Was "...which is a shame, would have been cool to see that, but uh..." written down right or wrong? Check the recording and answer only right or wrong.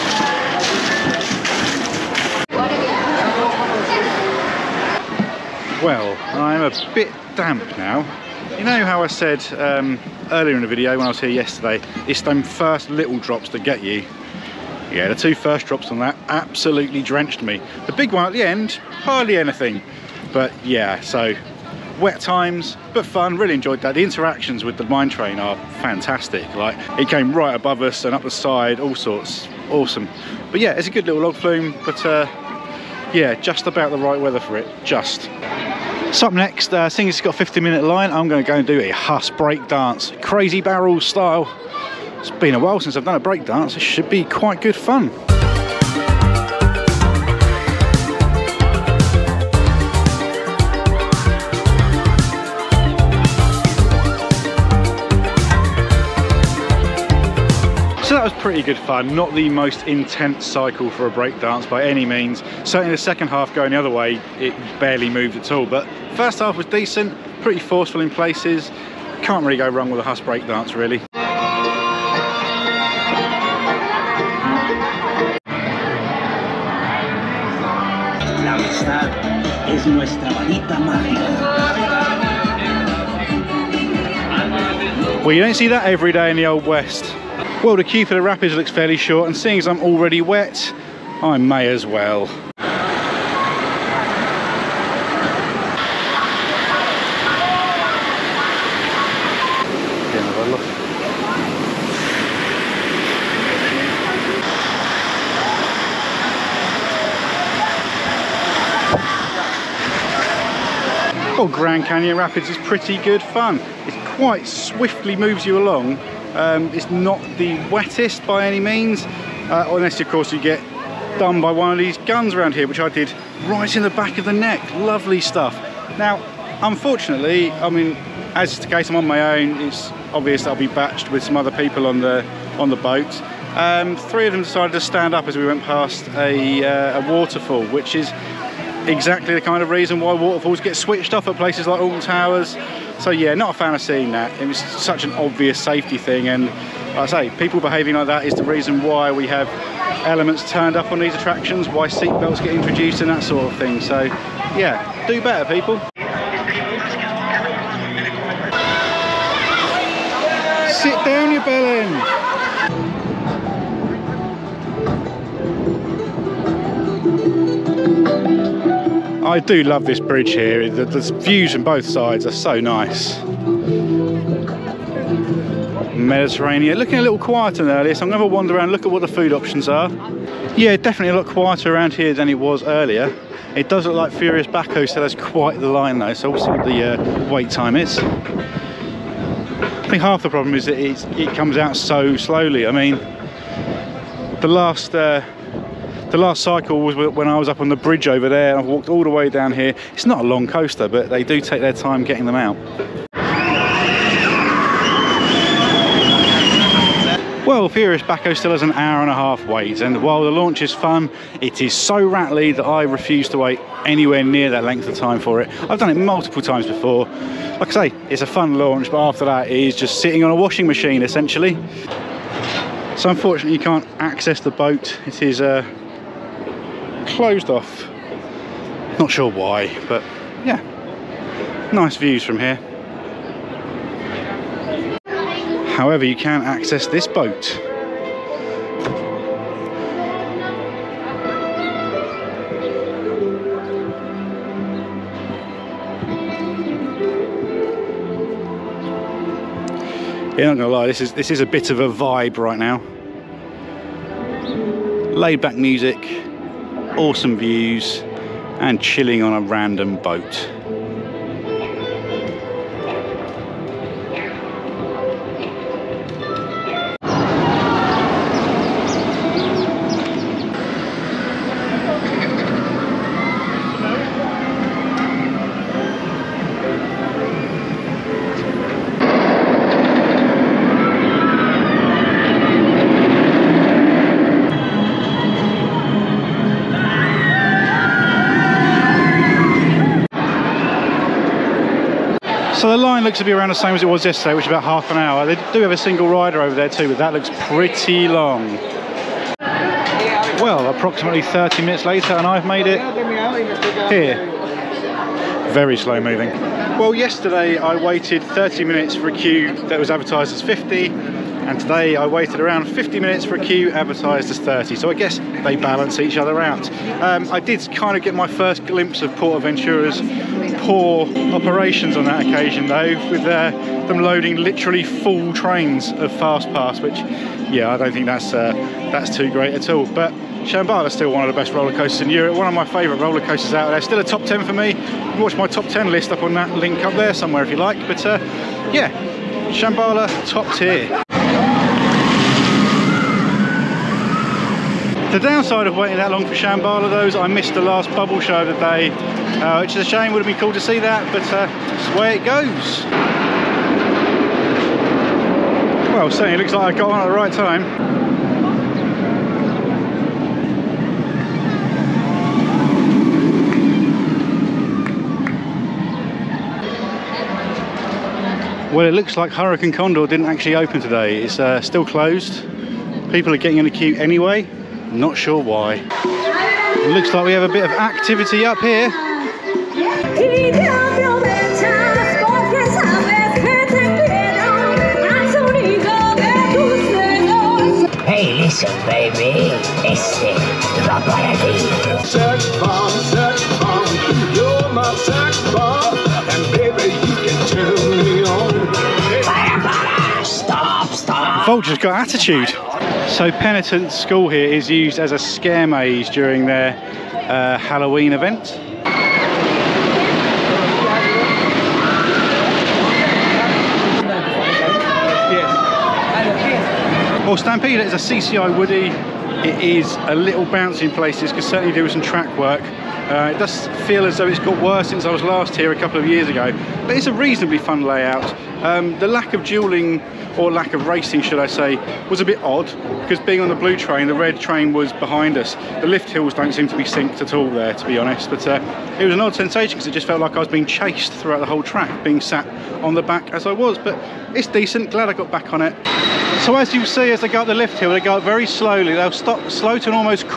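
right.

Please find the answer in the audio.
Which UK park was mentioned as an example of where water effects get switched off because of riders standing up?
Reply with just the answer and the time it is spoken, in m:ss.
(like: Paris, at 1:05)
Alton Towers, at 2:21.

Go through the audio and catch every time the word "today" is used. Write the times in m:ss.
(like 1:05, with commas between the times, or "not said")
5:11, 6:10.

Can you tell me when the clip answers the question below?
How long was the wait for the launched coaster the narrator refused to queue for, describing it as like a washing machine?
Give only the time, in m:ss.
3:28.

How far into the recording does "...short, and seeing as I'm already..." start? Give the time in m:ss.
1:28.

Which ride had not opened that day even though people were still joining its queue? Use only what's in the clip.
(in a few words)
Hurakan Condor.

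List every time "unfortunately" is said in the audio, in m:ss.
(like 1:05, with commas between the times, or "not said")
2:06, 3:43.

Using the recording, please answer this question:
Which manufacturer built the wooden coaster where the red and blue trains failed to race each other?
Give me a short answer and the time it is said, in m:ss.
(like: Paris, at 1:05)
CCI, at 6:57.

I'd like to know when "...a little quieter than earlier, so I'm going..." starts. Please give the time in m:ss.
2:56.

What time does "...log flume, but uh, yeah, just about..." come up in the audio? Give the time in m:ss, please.
0:31.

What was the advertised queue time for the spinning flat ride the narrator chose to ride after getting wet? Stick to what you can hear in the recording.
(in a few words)
15 minutes.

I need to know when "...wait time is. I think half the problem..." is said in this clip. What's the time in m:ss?
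3:07.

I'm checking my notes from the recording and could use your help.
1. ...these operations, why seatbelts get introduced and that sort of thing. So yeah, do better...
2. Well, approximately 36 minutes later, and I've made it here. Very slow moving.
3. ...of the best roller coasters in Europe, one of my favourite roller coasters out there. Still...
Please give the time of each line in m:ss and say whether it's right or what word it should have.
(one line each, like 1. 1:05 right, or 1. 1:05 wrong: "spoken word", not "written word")
1. 2:31 wrong: "attractions", not "operations"
2. 5:00 wrong: "30", not "36"
3. 5:31 right.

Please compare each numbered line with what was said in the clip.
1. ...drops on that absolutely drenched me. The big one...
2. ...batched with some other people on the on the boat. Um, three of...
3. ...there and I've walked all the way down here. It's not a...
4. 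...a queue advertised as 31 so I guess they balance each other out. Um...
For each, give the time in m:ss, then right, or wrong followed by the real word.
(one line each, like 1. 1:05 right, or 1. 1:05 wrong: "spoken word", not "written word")
1. 0:15 right
2. 2:10 right
3. 3:18 right
4. 5:13 wrong: "30", not "31".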